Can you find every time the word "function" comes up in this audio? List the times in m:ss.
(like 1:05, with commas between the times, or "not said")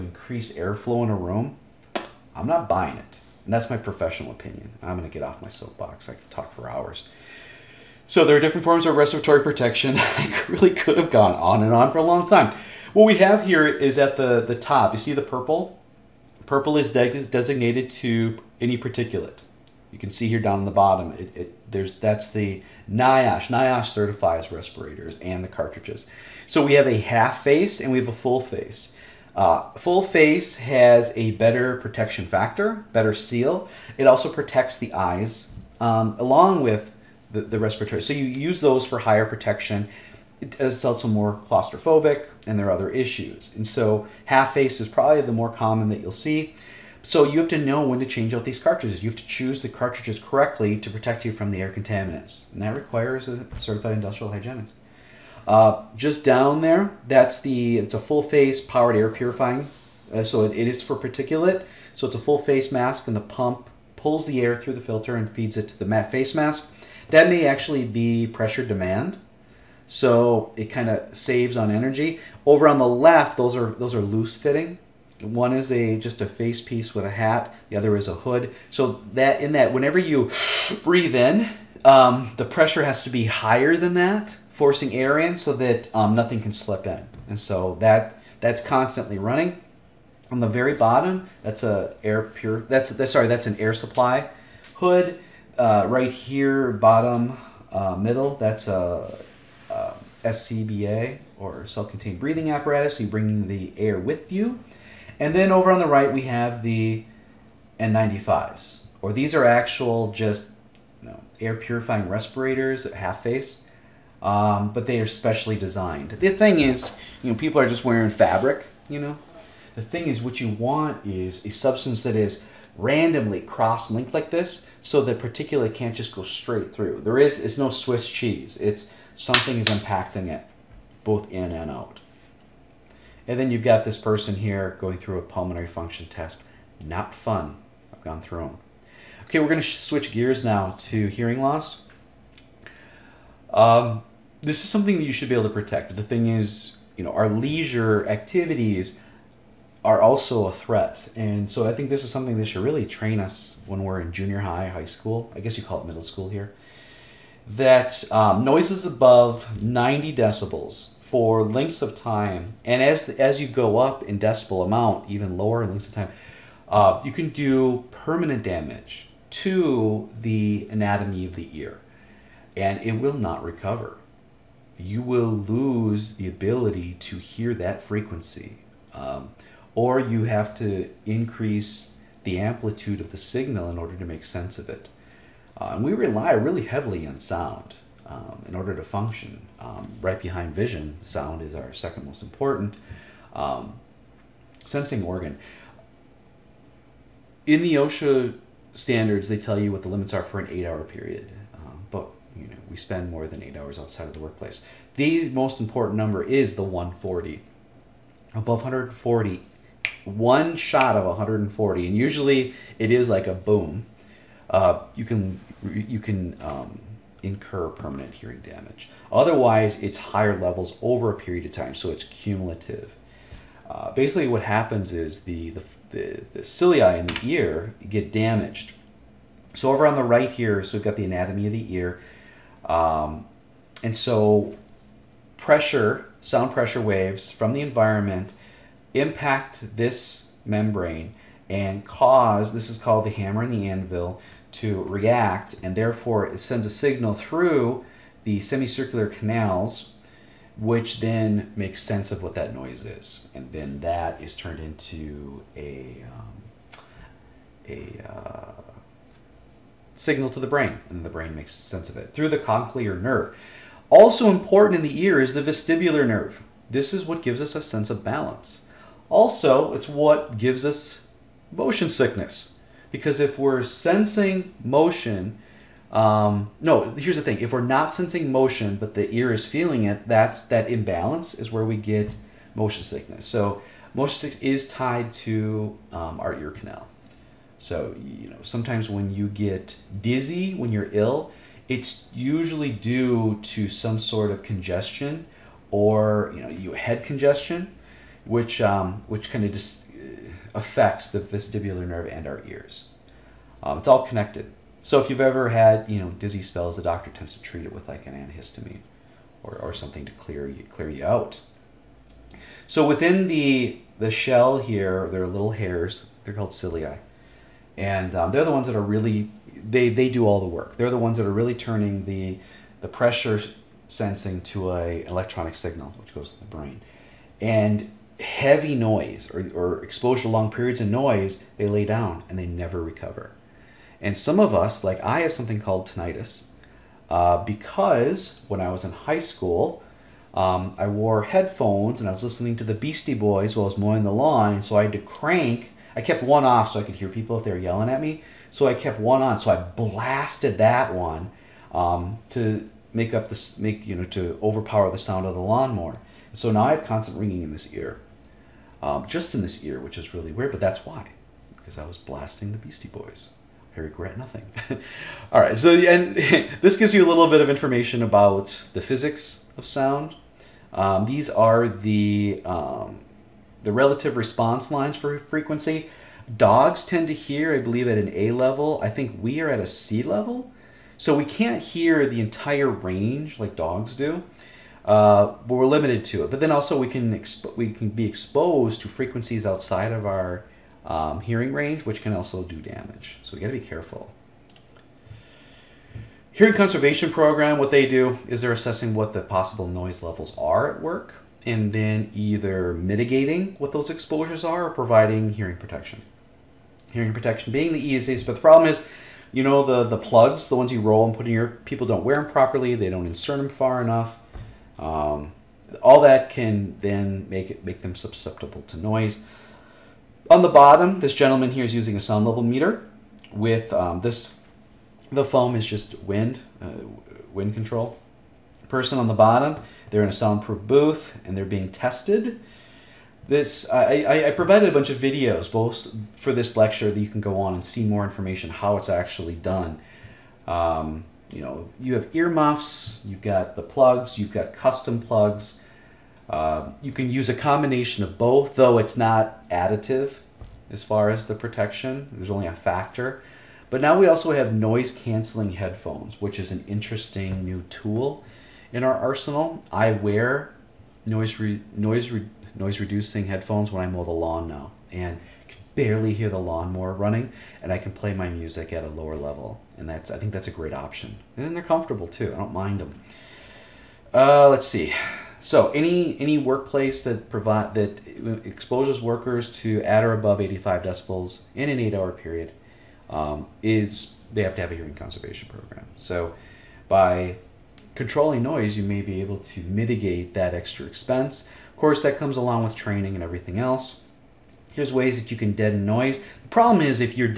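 2:15, 3:08.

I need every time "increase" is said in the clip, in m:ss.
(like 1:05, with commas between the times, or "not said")
0:00, 3:01.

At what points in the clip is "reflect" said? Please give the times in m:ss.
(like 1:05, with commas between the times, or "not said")
not said.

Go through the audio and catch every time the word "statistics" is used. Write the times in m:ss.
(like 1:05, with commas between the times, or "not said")
not said.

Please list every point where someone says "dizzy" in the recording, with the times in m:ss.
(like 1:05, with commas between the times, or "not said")
4:50, 5:06.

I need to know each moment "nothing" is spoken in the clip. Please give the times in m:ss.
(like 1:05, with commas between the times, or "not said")
1:26, 6:04.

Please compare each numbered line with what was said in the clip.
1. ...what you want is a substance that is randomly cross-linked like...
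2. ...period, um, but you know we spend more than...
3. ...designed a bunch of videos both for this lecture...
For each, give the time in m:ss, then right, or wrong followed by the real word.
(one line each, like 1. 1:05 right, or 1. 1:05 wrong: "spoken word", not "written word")
1. 2:00 right
2. 3:20 right
3. 7:14 wrong: "provided", not "designed".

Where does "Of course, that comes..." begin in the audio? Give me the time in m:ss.
8:11.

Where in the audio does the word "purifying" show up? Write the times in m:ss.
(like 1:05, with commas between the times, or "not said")
0:59, 1:51.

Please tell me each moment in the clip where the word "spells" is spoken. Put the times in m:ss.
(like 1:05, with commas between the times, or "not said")
5:06.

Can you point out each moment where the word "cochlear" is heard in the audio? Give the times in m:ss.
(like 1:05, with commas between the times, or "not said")
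4:22.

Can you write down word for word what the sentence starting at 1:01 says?
So it's a full face mask and the pump pulls the air through the filter and feeds it to the face mask.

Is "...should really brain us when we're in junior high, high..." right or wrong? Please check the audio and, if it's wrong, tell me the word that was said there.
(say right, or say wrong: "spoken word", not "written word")
wrong: "train", not "brain".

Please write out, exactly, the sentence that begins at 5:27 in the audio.
And heavy noise or, or exposure to long periods of noise, they lay down and they never recover.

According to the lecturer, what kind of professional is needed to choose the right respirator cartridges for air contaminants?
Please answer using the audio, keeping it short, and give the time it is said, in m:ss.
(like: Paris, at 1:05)
Certified industrial hygienist, at 0:53.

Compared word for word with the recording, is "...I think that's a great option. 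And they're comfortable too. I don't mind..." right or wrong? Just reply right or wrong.
right.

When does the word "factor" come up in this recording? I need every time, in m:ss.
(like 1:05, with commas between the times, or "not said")
0:32, 7:32.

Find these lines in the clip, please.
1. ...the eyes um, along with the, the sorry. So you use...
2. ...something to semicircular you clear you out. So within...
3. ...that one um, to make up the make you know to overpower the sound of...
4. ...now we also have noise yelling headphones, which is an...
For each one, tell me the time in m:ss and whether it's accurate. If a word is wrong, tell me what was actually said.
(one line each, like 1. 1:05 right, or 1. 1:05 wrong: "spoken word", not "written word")
1. 0:34 wrong: "respiratory", not "sorry"
2. 5:09 wrong: "clear", not "semicircular"
3. 5:50 right
4. 7:33 wrong: "canceling", not "yelling".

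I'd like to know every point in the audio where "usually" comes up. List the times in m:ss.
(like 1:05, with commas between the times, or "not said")
3:31, 4:52.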